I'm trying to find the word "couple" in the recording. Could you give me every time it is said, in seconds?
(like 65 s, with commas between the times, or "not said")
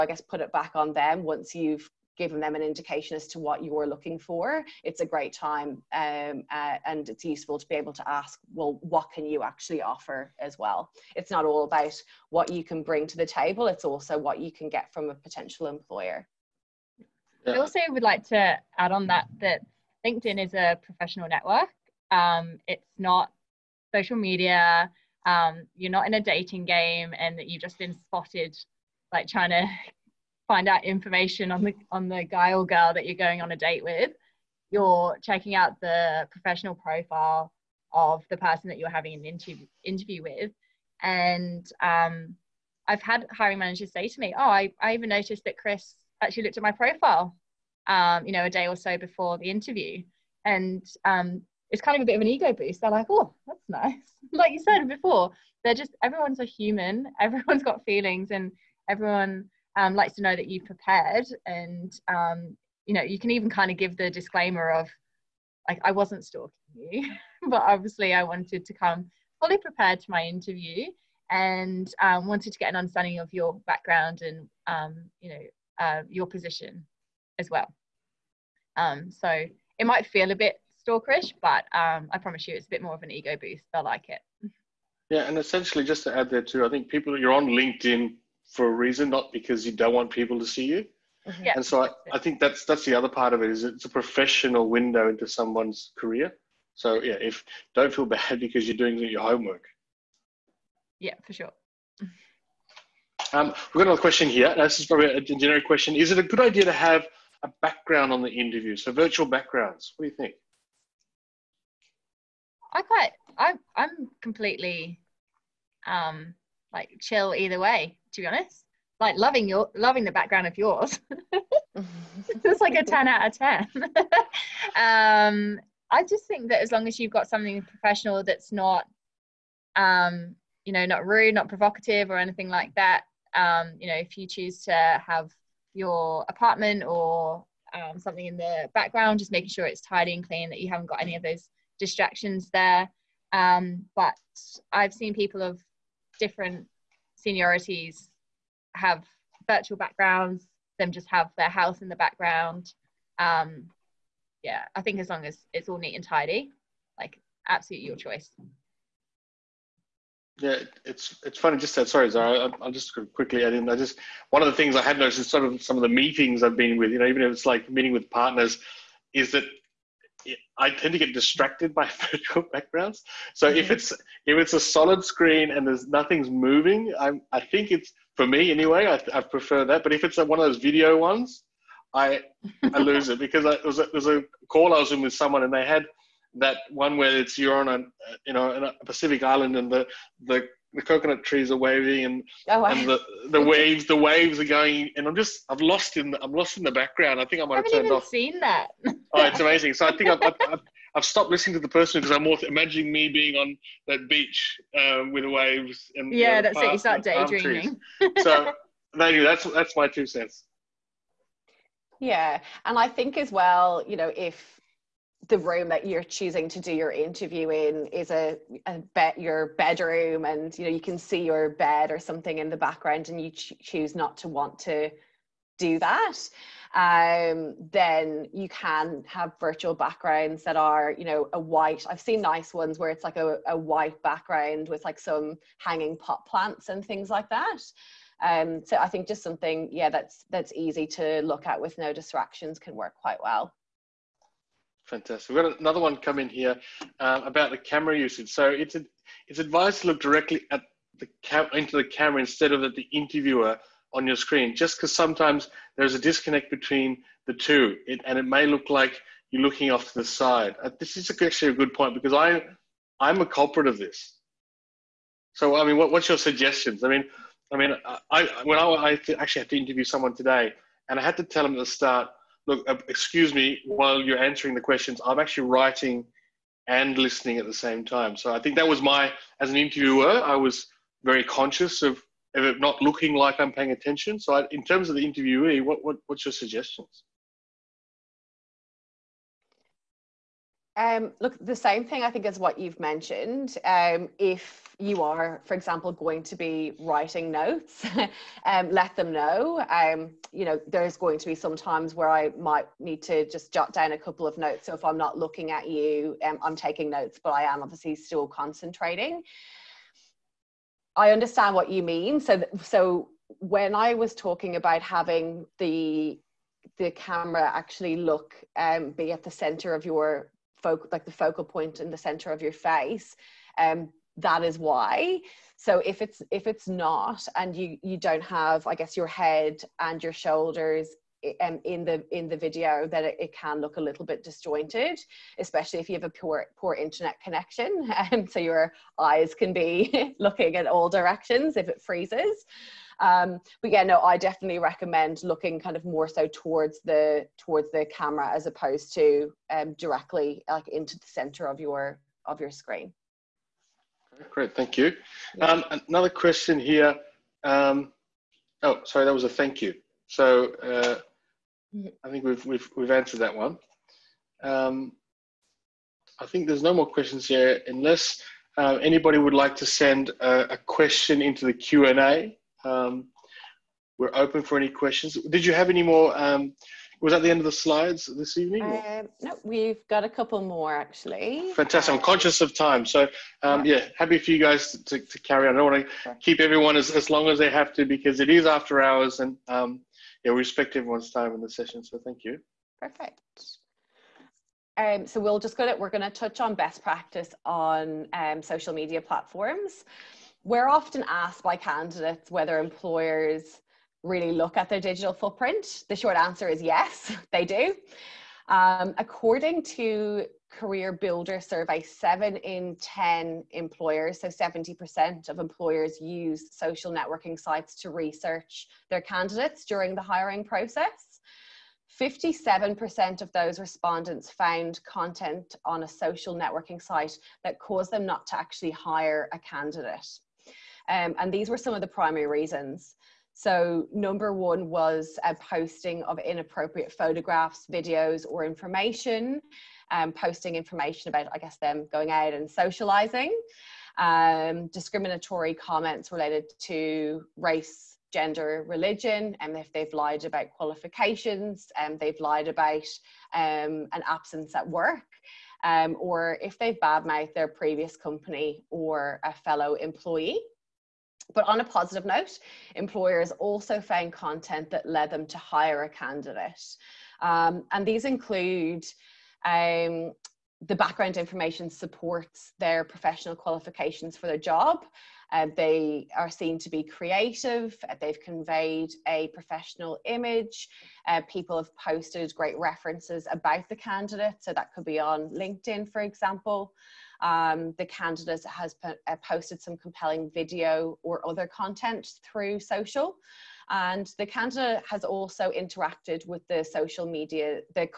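303 s, 380 s.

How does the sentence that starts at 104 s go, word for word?
This is probably a generic question.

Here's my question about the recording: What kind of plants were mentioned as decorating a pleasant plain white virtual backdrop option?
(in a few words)
hanging pot plants.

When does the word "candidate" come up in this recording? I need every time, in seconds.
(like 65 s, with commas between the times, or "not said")
401 s, 419 s, 429 s, 465 s, 483 s, 487 s, 494 s.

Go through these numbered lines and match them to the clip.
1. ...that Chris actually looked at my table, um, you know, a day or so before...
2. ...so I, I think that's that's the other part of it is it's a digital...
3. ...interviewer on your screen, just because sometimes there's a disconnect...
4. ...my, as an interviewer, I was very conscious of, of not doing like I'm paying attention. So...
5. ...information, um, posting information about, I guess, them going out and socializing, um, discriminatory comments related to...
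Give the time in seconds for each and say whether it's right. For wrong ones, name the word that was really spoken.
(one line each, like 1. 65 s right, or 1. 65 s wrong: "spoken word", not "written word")
1. 45 s wrong: "profile", not "table"
2. 91 s wrong: "professional", not "digital"
3. 252 s right
4. 278 s wrong: "looking", not "doing"
5. 438 s right.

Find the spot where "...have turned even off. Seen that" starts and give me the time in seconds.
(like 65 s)
197 s.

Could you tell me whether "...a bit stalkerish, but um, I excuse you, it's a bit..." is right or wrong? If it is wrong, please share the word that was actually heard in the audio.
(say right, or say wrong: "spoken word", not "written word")
wrong: "promise", not "excuse".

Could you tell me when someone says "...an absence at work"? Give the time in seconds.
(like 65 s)
453 s.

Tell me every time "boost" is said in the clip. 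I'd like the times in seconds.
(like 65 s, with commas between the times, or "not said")
52 s, 83 s.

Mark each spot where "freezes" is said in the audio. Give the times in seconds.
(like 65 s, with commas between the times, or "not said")
341 s.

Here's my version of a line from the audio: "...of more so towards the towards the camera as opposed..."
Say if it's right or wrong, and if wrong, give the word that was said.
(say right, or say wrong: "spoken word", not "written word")
right.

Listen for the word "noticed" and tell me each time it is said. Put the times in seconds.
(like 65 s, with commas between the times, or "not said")
45 s, 164 s.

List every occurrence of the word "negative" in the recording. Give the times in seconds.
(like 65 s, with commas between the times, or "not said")
not said.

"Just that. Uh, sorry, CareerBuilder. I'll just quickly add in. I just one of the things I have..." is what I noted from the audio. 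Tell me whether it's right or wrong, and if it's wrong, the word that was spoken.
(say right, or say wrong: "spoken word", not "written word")
wrong: "Zara", not "CareerBuilder".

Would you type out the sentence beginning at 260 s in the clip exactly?
Uh, this is actually a good point because I I'm a culprit of this.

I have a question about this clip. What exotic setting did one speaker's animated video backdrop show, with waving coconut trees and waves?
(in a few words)
Pacific island.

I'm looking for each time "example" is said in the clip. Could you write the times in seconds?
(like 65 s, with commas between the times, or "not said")
295 s, 486 s.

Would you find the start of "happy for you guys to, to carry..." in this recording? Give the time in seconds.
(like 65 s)
383 s.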